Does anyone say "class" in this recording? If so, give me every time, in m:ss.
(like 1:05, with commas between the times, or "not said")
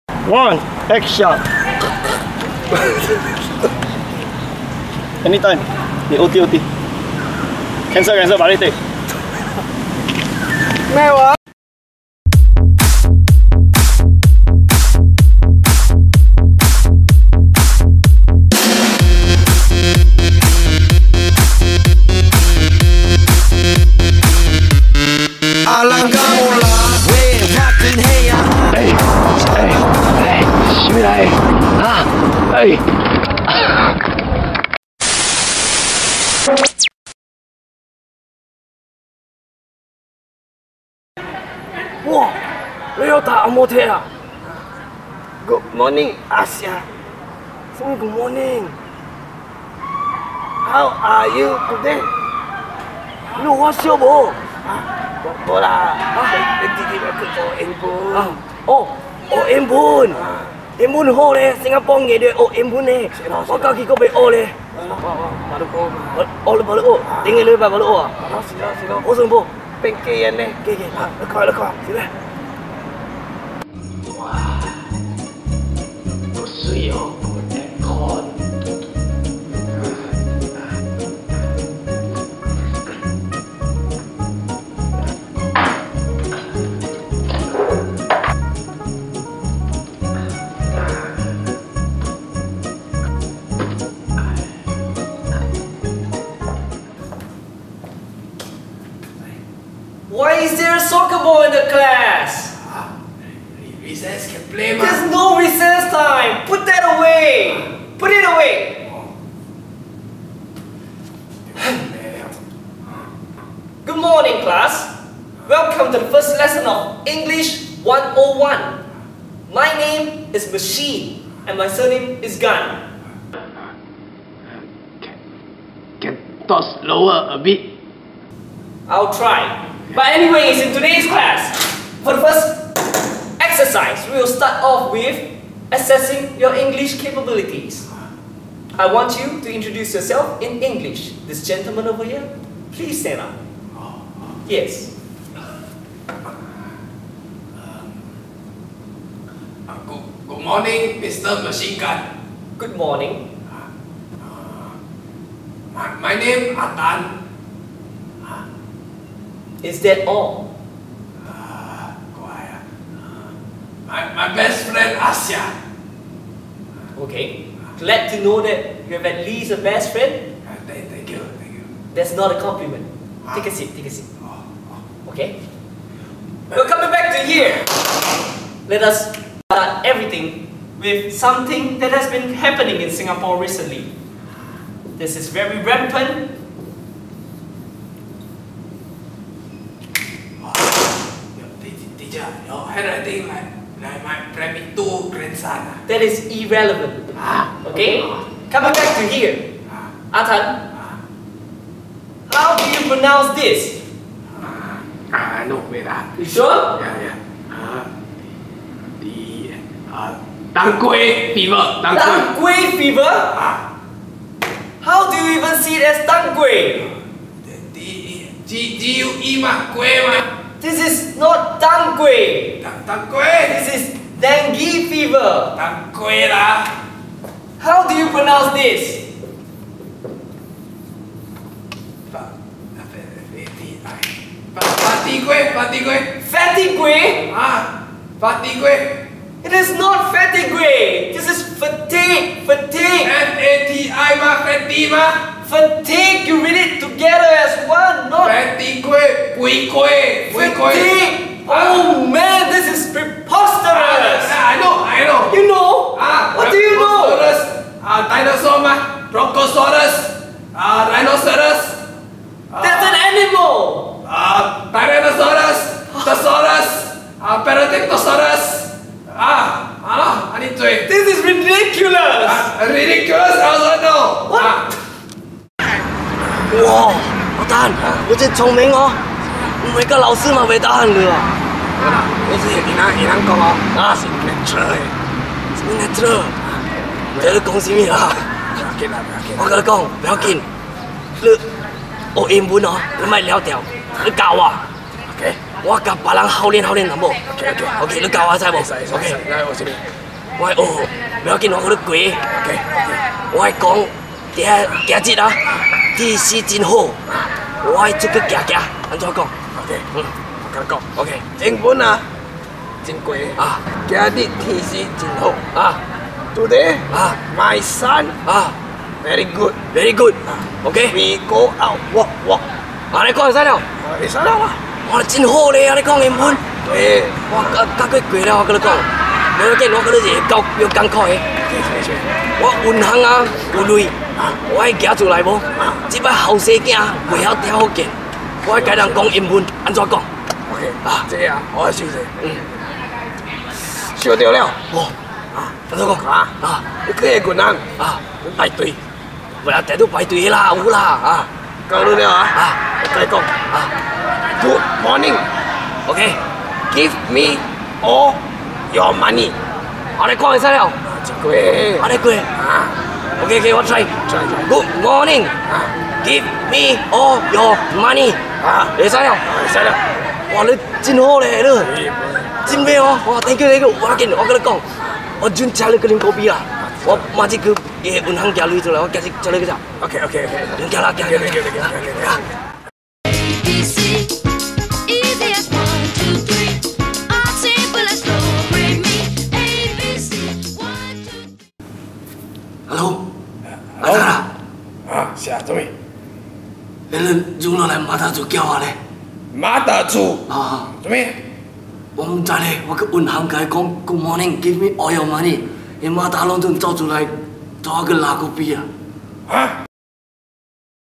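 1:41, 1:54, 2:11.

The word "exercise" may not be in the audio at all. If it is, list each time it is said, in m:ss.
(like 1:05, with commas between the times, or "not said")
2:13.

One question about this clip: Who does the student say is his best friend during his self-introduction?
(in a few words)
Asya.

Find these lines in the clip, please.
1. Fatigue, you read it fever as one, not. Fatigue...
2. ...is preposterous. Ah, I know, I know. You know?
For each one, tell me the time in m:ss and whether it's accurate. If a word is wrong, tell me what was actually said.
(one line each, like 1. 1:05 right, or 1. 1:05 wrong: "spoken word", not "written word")
1. 4:05 wrong: "together", not "fever"
2. 4:12 right.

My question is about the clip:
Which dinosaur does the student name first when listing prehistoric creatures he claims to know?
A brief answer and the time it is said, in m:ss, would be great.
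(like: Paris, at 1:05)
Brontosaurus, at 4:19.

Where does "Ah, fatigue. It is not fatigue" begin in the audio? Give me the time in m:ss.
3:57.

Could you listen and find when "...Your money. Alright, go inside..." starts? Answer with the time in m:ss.
5:58.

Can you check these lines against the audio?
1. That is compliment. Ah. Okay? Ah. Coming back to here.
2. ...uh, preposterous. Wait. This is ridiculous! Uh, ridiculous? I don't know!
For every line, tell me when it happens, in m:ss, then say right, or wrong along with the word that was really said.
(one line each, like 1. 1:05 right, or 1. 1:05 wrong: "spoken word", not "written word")
1. 3:15 wrong: "irrelevant", not "compliment"
2. 4:27 wrong: "paradigmosaurus", not "preposterous".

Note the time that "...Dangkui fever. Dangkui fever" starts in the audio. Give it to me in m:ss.
3:30.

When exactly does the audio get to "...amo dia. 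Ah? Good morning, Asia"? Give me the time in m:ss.
0:43.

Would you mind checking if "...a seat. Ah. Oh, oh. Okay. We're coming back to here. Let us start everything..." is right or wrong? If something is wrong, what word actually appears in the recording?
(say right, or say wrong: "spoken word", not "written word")
right.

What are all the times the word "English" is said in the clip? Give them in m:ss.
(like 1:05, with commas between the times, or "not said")
1:57, 2:16, 2:20.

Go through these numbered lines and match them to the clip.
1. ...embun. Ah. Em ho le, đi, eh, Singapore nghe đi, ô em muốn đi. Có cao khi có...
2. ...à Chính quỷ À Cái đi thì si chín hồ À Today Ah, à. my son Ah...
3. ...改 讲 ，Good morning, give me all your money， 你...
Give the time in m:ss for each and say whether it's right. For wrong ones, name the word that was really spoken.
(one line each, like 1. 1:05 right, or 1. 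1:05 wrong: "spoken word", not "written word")
1. 0:59 right
2. 5:11 right
3. 6:43 right.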